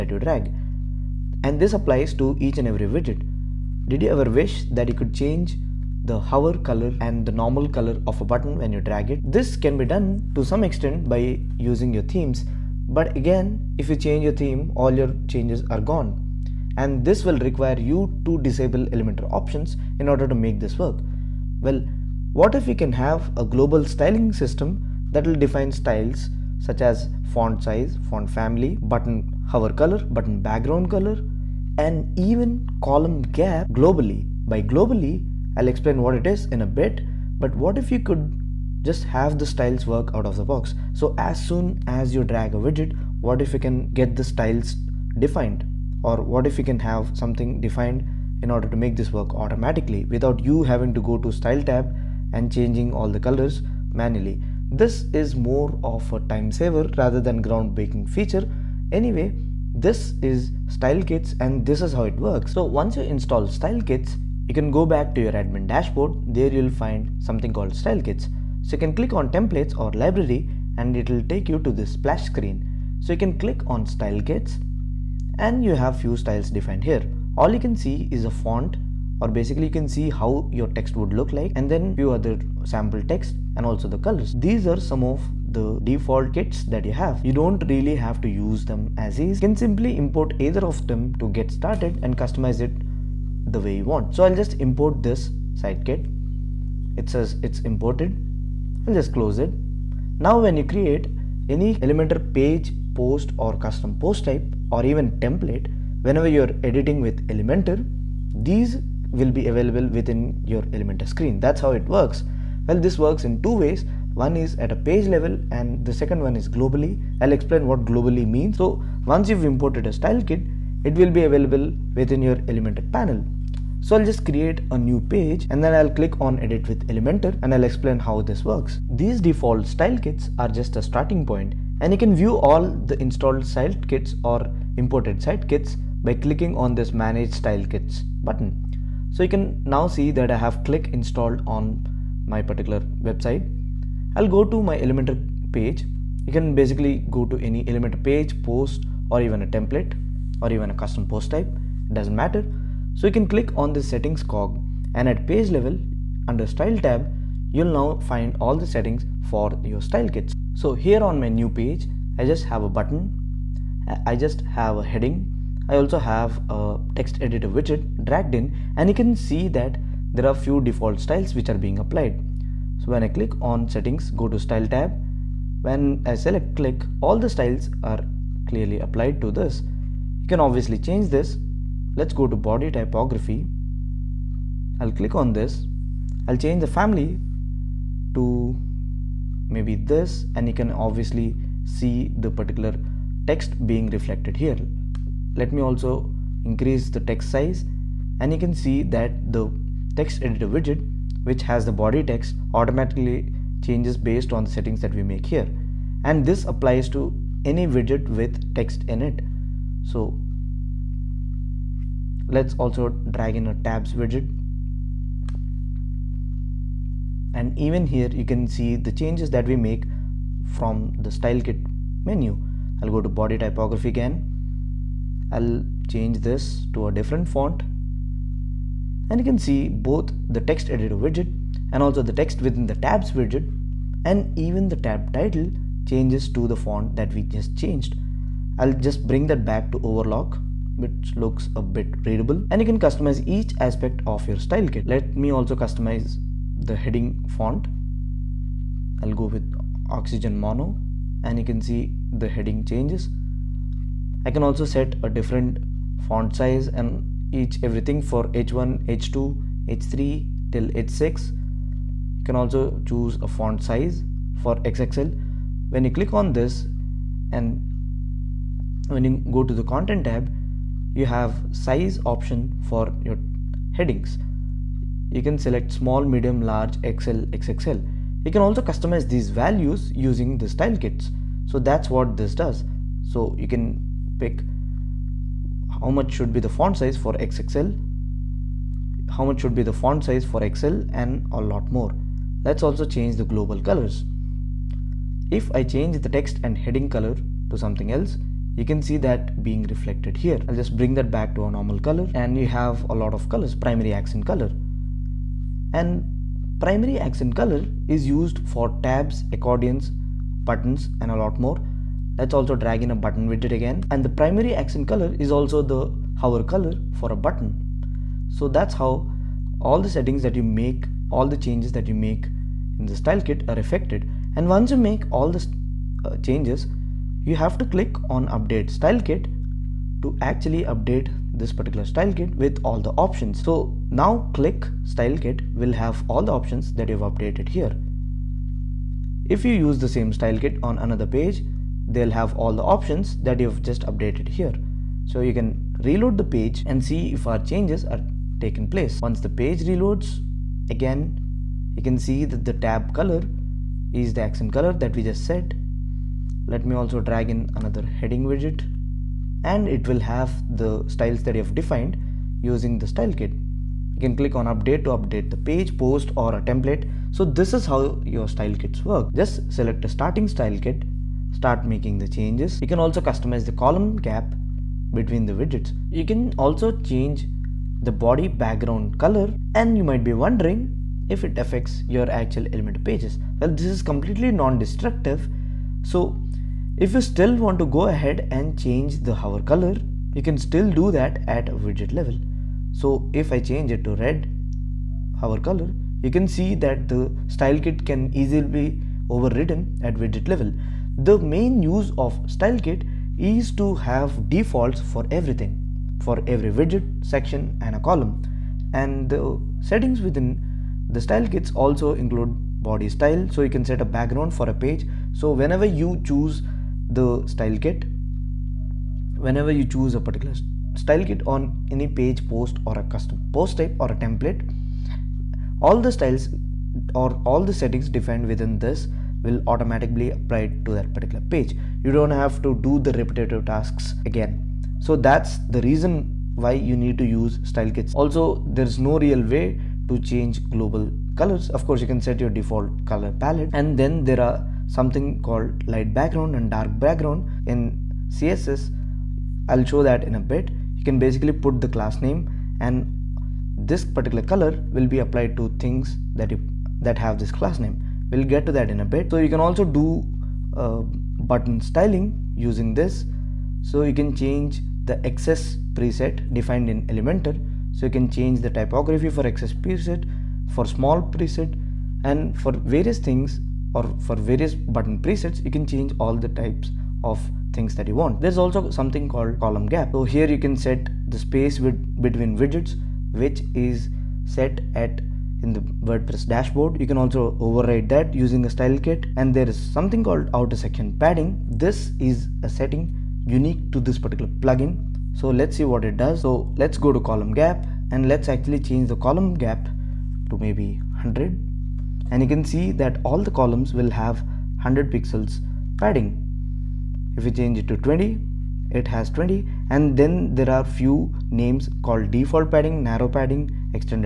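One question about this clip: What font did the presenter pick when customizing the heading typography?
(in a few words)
Oxygen Mono.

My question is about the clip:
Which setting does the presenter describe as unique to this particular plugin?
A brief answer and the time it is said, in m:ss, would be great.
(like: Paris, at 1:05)
outer section padding, at 8:10.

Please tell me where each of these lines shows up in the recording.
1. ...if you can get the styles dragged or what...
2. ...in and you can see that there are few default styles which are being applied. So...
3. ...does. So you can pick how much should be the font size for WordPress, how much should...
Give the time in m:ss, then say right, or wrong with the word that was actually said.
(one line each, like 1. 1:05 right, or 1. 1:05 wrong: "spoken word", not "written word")
1. 0:43 wrong: "defined", not "dragged"
2. 2:48 right
3. 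4:42 wrong: "XXL", not "WordPress".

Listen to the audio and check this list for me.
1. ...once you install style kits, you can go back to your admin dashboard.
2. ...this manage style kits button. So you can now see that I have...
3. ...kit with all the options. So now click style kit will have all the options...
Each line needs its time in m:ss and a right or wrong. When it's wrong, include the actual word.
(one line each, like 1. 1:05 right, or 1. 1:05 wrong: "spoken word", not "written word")
1. 1:02 right
2. 2:16 right
3. 5:32 right.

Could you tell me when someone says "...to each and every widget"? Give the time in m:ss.
0:02.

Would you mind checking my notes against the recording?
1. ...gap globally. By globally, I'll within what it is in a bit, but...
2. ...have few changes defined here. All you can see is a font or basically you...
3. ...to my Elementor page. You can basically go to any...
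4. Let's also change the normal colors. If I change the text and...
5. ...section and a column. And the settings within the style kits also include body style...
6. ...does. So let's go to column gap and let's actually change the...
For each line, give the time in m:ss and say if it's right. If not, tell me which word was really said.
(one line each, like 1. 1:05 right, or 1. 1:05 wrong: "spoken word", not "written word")
1. 0:33 wrong: "explain", not "within"
2. 1:15 wrong: "styles", not "changes"
3. 2:24 right
4. 4:52 wrong: "global", not "normal"
5. 6:47 right
6. 8:15 right.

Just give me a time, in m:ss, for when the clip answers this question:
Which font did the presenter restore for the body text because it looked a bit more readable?
3:59.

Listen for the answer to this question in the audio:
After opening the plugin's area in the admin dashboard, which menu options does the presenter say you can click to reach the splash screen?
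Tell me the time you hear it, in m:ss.
1:09.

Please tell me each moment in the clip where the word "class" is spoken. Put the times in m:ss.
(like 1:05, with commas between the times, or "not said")
7:31, 7:37.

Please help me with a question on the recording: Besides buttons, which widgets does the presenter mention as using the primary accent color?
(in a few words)
tabs, accordions.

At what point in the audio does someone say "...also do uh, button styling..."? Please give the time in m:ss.
7:39.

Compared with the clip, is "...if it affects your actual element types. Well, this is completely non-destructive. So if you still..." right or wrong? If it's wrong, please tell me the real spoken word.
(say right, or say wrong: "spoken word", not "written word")
wrong: "pages", not "types".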